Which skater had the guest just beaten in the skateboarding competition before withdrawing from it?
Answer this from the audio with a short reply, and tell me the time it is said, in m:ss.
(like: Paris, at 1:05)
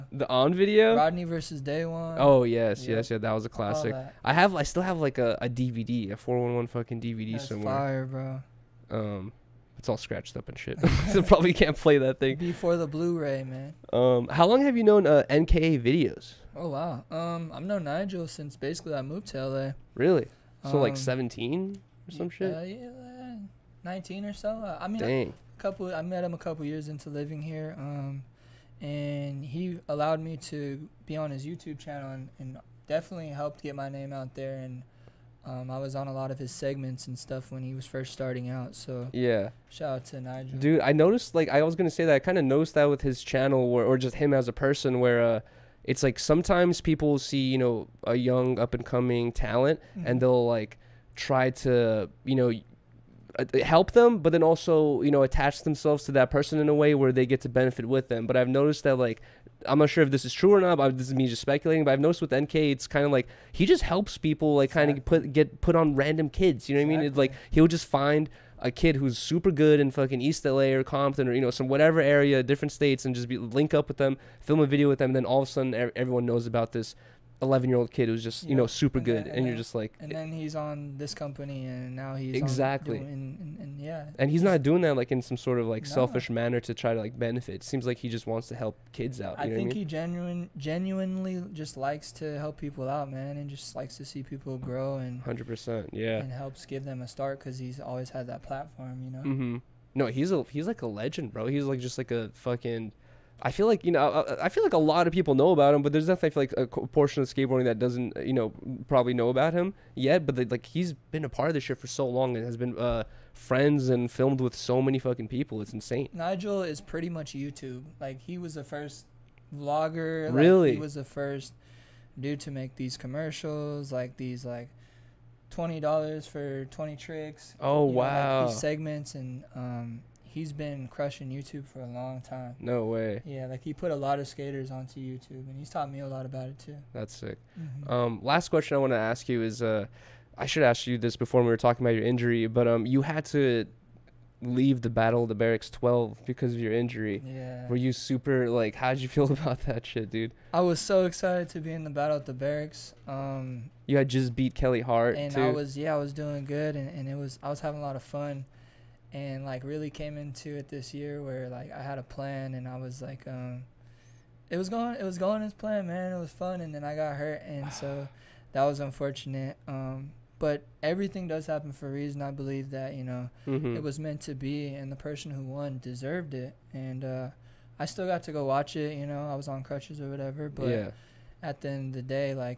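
Kelly Hart, at 2:34.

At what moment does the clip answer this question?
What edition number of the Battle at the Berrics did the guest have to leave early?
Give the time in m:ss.
2:25.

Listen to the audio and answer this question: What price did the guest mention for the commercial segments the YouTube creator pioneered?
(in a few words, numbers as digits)
$20.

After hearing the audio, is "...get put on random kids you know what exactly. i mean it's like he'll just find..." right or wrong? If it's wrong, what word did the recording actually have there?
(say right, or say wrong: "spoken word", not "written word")
right.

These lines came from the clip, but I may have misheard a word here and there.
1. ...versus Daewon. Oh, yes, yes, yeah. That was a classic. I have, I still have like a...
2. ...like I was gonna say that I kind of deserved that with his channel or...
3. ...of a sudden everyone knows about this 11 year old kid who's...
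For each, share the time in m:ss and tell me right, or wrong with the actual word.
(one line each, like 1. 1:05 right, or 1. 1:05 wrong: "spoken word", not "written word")
1. 0:01 right
2. 0:41 wrong: "noticed", not "deserved"
3. 1:15 right.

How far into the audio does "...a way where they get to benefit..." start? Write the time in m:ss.
0:56.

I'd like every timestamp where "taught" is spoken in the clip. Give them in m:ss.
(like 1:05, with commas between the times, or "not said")
2:15.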